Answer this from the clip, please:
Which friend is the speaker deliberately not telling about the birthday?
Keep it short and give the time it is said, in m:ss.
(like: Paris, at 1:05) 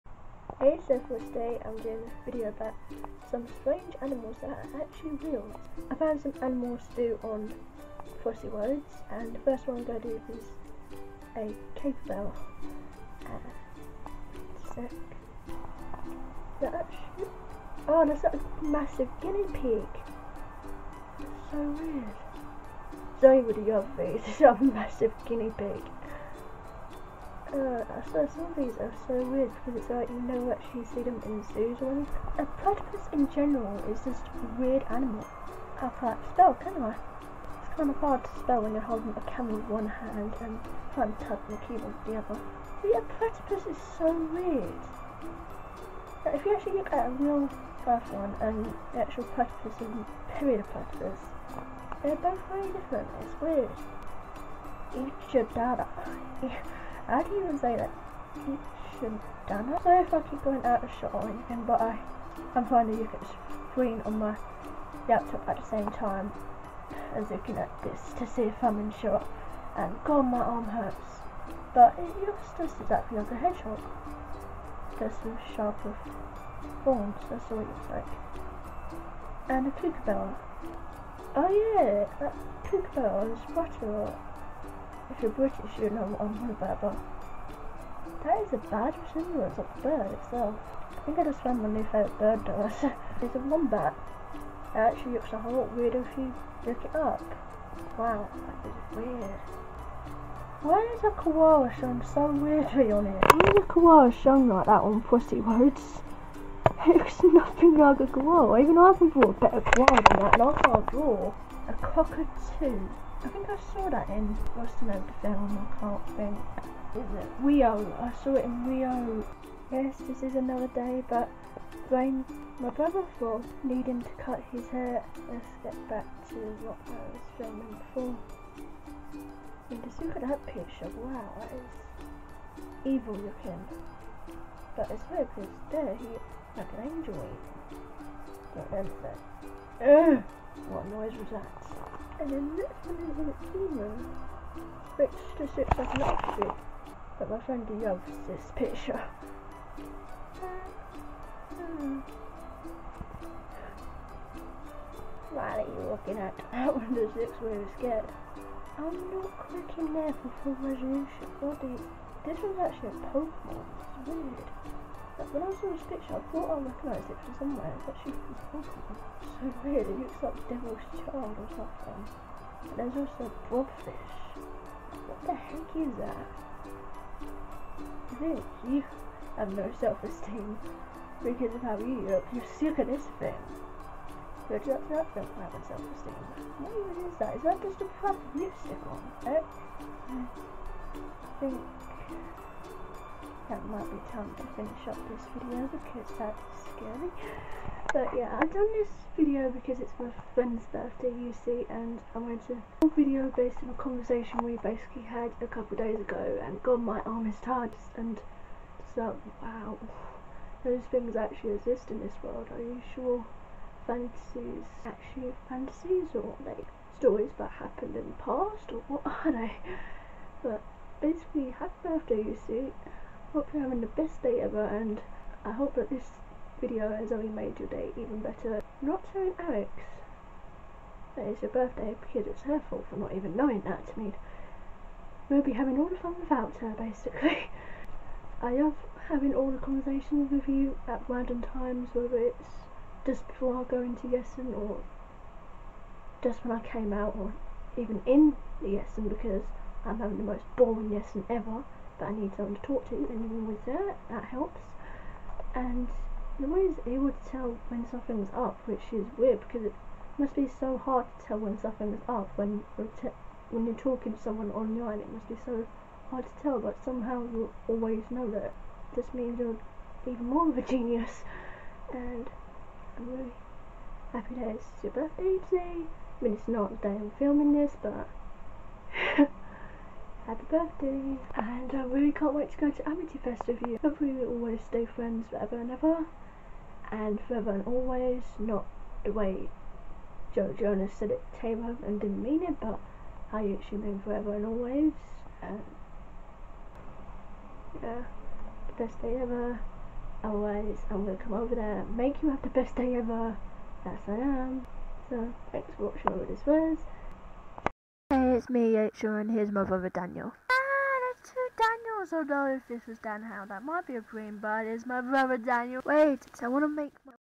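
Alex, at 3:49.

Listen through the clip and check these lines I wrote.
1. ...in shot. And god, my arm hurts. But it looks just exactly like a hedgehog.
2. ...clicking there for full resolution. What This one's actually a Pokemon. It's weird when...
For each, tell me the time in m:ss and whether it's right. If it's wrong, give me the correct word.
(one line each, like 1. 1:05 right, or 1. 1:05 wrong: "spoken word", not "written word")
1. 1:08 right
2. 2:39 right.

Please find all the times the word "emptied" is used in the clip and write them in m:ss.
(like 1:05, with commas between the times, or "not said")
not said.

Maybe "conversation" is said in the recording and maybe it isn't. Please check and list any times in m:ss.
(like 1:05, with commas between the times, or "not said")
3:23, 3:59.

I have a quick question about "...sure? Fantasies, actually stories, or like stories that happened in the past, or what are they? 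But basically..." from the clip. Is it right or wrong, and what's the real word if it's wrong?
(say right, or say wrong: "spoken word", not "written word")
wrong: "fantasies", not "stories".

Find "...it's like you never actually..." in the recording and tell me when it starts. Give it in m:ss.
0:29.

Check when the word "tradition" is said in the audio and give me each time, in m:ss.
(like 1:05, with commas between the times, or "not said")
not said.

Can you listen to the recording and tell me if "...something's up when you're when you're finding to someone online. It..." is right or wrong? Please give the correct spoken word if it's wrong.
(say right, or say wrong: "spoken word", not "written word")
wrong: "talking", not "finding".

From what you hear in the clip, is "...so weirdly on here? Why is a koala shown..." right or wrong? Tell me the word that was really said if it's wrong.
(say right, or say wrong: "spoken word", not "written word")
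right.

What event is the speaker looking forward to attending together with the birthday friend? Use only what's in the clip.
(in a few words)
Amityfest.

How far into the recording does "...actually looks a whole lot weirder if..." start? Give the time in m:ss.
1:34.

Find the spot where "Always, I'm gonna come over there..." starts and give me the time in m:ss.
5:00.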